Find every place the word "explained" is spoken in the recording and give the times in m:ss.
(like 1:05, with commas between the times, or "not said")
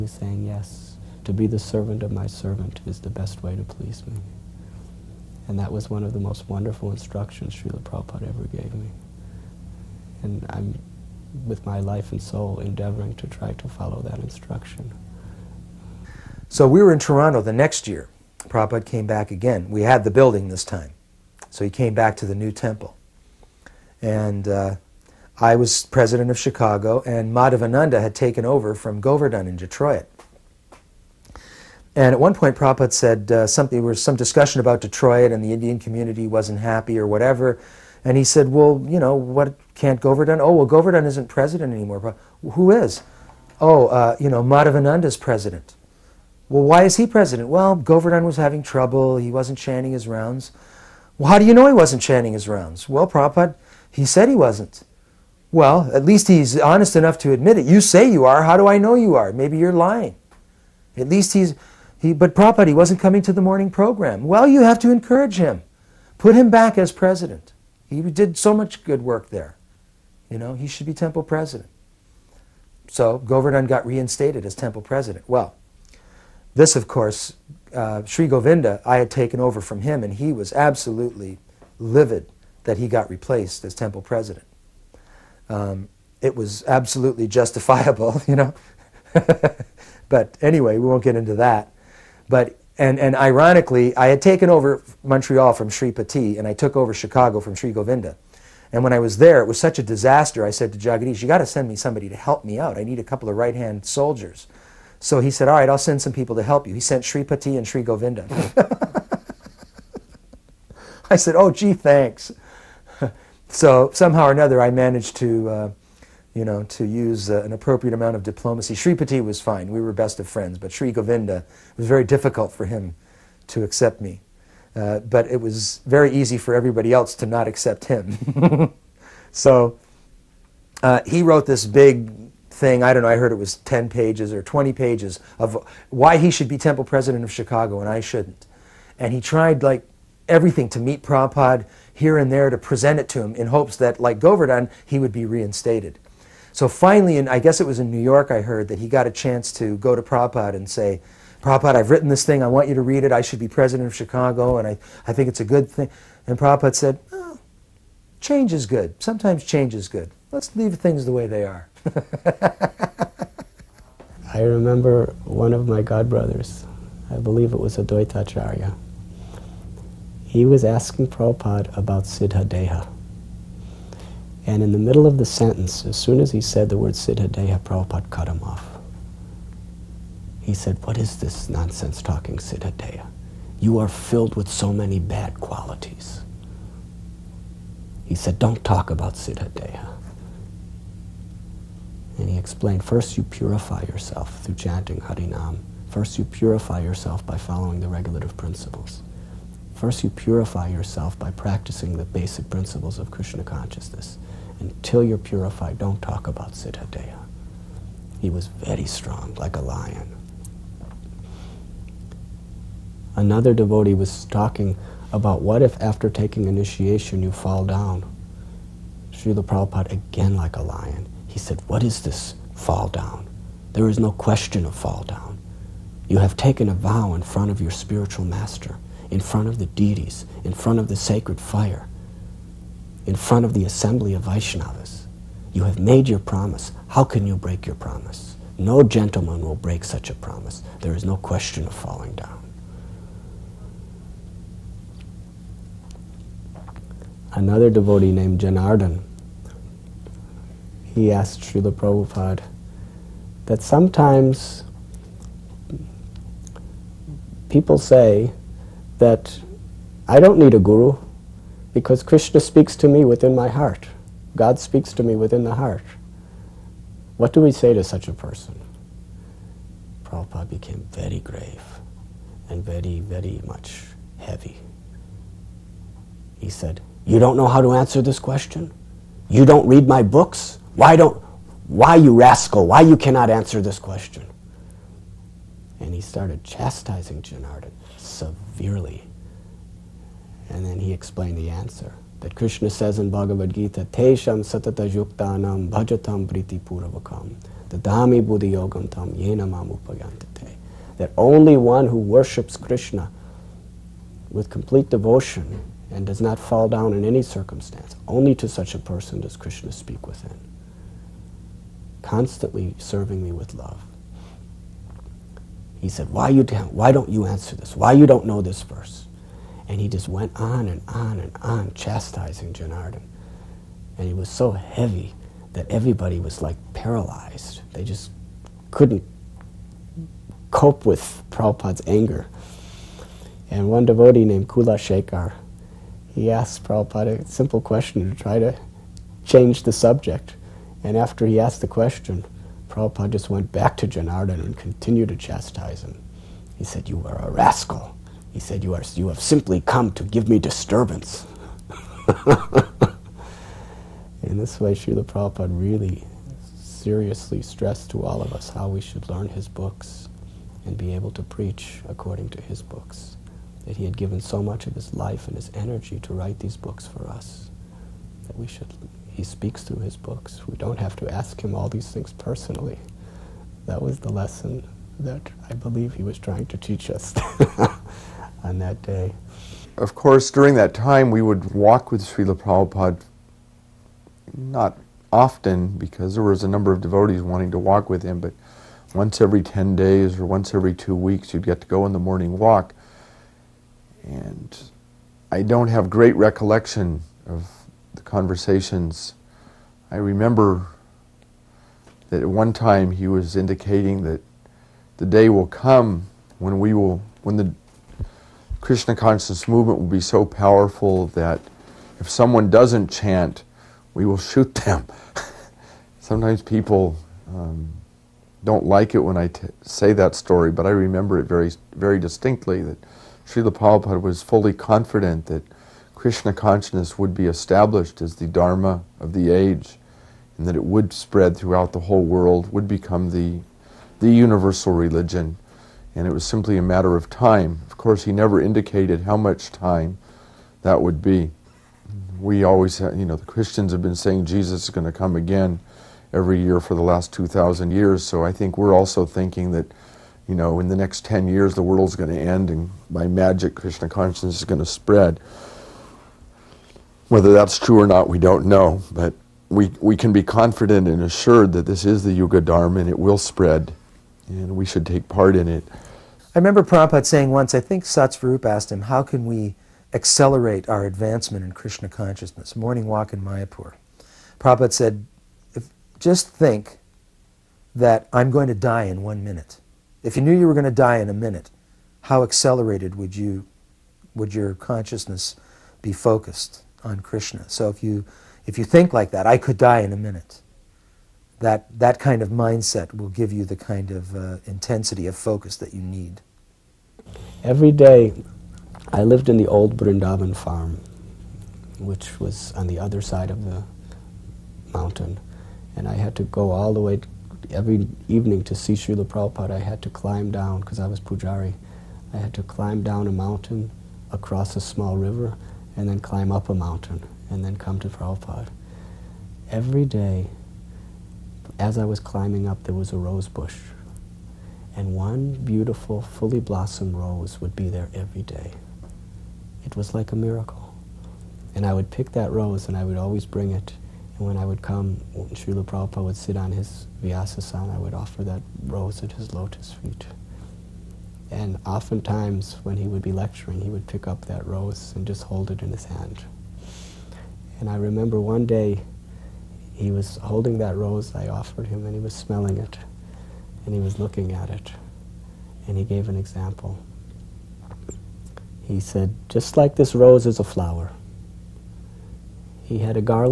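3:12, 4:50.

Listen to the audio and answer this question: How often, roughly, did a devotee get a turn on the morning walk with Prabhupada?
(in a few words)
every 10 days.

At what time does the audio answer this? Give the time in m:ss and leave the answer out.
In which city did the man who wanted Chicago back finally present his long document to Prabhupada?
2:27.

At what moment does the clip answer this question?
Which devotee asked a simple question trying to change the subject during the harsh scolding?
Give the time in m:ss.
5:34.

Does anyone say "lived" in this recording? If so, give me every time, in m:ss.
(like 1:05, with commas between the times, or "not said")
8:19.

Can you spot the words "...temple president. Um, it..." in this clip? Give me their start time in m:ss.
1:23.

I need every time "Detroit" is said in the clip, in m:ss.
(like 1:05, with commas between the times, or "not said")
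0:29, 0:34.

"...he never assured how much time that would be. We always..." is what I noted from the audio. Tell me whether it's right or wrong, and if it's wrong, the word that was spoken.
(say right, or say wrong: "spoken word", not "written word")
wrong: "indicated", not "assured".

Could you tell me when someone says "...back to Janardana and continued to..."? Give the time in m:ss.
5:43.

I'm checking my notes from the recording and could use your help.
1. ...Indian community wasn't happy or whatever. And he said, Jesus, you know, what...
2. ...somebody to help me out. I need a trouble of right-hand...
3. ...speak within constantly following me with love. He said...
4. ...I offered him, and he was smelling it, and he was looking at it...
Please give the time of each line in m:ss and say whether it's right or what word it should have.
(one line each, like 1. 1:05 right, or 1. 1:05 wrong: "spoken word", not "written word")
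1. 0:35 wrong: "Well", not "Jesus"
2. 1:41 wrong: "couple", not "trouble"
3. 5:09 wrong: "serving", not "following"
4. 9:11 right.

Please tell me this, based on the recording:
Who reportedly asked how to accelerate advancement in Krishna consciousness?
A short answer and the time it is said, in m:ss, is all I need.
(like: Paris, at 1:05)
Satsvarup, at 7:47.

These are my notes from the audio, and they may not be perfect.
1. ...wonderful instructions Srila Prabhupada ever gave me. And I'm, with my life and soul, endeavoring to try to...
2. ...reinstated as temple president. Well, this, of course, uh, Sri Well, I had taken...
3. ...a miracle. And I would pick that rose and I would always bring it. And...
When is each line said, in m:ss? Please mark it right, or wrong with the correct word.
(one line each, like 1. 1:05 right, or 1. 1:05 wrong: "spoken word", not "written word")
1. 0:06 right
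2. 1:13 wrong: "Govinda", not "Well"
3. 8:50 right.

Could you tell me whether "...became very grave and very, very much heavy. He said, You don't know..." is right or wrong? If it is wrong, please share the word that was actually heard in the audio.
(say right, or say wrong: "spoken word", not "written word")
right.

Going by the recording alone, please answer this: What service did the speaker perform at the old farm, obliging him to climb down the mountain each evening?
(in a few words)
Pujari.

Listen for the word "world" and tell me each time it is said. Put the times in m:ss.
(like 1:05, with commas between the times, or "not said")
7:12, 7:31.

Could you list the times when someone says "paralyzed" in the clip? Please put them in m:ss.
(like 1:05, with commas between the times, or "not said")
5:26.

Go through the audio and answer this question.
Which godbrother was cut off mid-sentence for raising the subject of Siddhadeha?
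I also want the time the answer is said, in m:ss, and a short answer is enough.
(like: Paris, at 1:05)
Advaitacharya, at 2:47.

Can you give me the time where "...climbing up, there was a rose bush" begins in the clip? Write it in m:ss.
8:42.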